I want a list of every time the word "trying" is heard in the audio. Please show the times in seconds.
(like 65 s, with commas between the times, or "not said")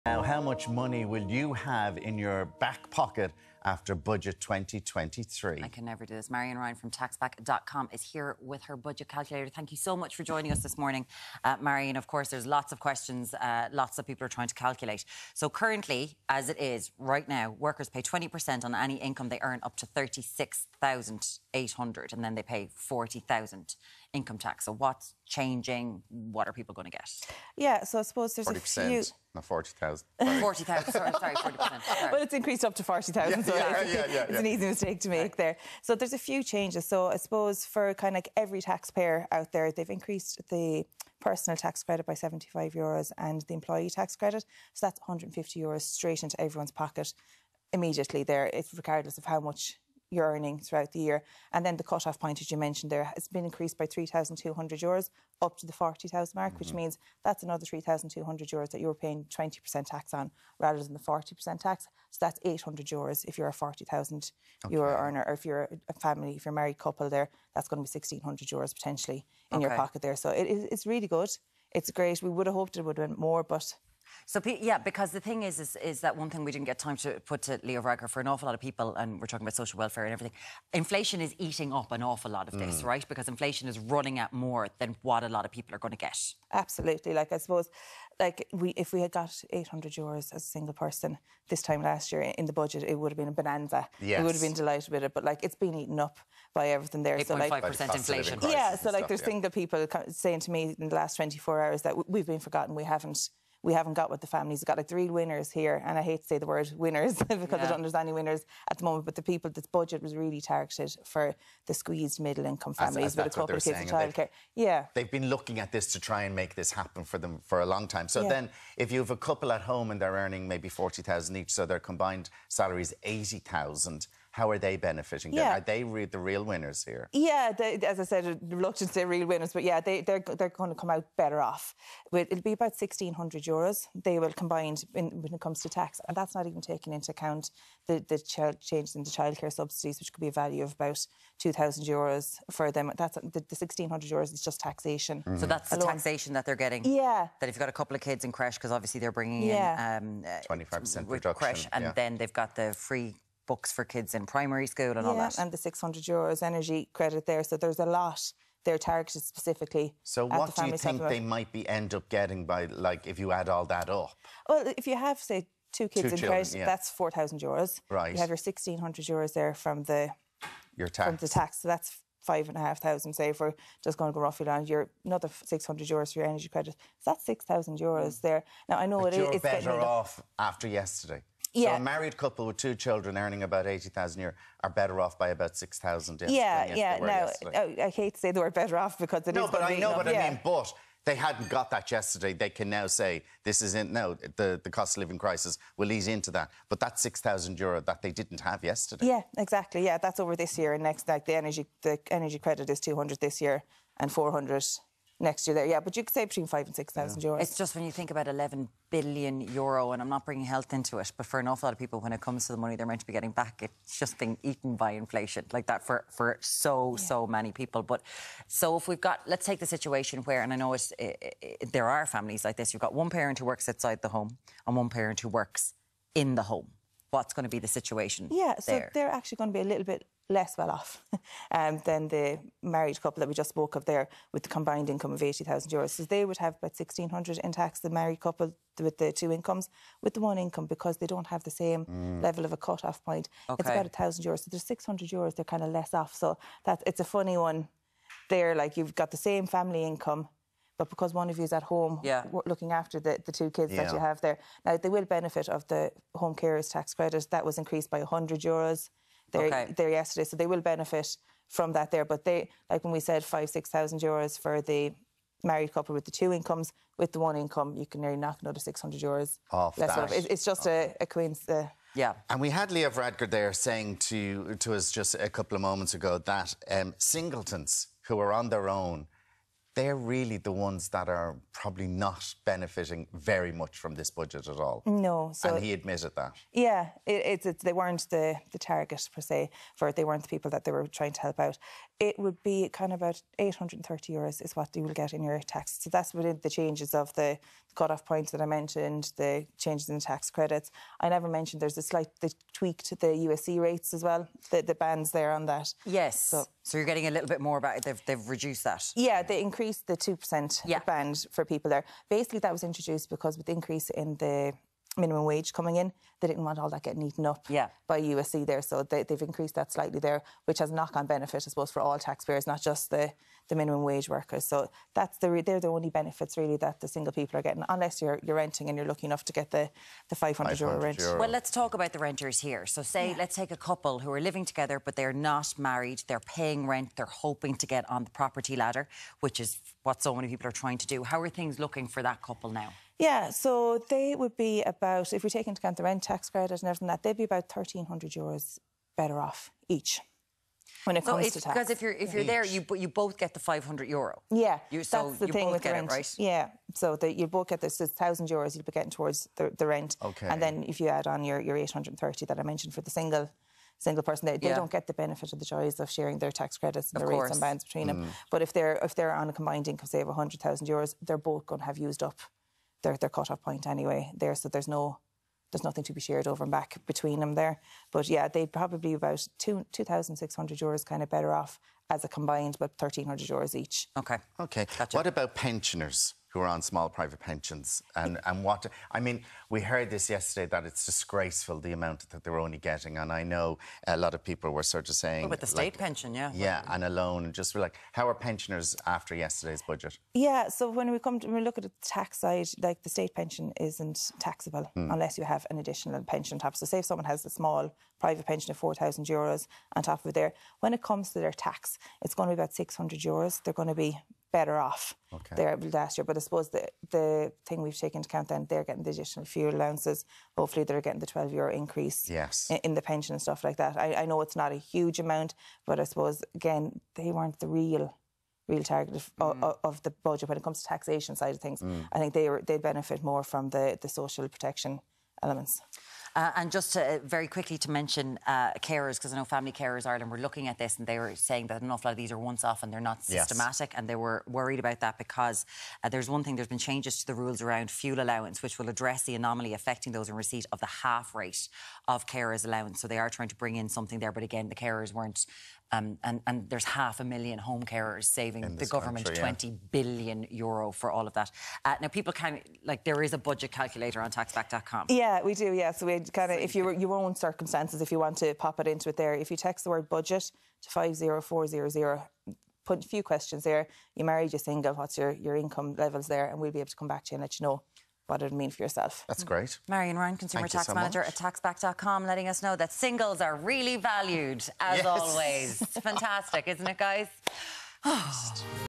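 14 s, 290 s, 340 s, 453 s.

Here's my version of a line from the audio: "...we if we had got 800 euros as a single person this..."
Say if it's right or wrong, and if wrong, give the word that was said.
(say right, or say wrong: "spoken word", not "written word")
right.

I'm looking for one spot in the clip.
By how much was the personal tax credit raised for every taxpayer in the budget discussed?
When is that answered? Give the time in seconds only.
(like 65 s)
42 s.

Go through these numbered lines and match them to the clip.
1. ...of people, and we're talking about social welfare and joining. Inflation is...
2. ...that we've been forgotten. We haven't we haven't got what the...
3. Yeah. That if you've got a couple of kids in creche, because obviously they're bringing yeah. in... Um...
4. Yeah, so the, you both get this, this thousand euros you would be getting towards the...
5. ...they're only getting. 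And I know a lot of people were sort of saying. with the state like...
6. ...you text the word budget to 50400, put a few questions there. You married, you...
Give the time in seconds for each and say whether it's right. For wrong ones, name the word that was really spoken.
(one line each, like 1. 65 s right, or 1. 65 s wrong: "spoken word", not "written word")
1. 78 s wrong: "everything", not "joining"
2. 101 s right
3. 146 s right
4. 356 s right
5. 392 s right
6. 469 s right.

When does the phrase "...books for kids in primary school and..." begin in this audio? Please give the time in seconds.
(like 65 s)
153 s.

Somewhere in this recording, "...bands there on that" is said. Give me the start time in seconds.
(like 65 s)
304 s.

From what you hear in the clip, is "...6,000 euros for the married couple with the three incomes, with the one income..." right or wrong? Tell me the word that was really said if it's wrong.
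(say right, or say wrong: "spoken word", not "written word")
wrong: "two", not "three".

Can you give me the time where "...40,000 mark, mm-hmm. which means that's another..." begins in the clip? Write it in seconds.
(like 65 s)
55 s.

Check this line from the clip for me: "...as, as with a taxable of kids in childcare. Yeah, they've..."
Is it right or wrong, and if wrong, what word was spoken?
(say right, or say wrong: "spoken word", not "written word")
wrong: "couple", not "taxable".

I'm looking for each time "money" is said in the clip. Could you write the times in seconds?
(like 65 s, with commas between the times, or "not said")
0 s, 212 s.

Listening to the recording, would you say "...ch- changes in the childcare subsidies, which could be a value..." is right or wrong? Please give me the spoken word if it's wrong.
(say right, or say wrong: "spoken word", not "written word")
right.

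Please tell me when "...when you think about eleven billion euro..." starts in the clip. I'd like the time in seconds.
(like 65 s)
207 s.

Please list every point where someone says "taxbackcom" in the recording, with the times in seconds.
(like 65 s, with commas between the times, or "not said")
6 s, 464 s, 481 s.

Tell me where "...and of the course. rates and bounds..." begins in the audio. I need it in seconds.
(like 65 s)
366 s.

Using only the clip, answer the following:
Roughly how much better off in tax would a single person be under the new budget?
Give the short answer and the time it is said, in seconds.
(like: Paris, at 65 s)
830 euros, at 293 s.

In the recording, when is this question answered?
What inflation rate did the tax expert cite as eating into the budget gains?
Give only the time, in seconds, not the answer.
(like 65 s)
97 s.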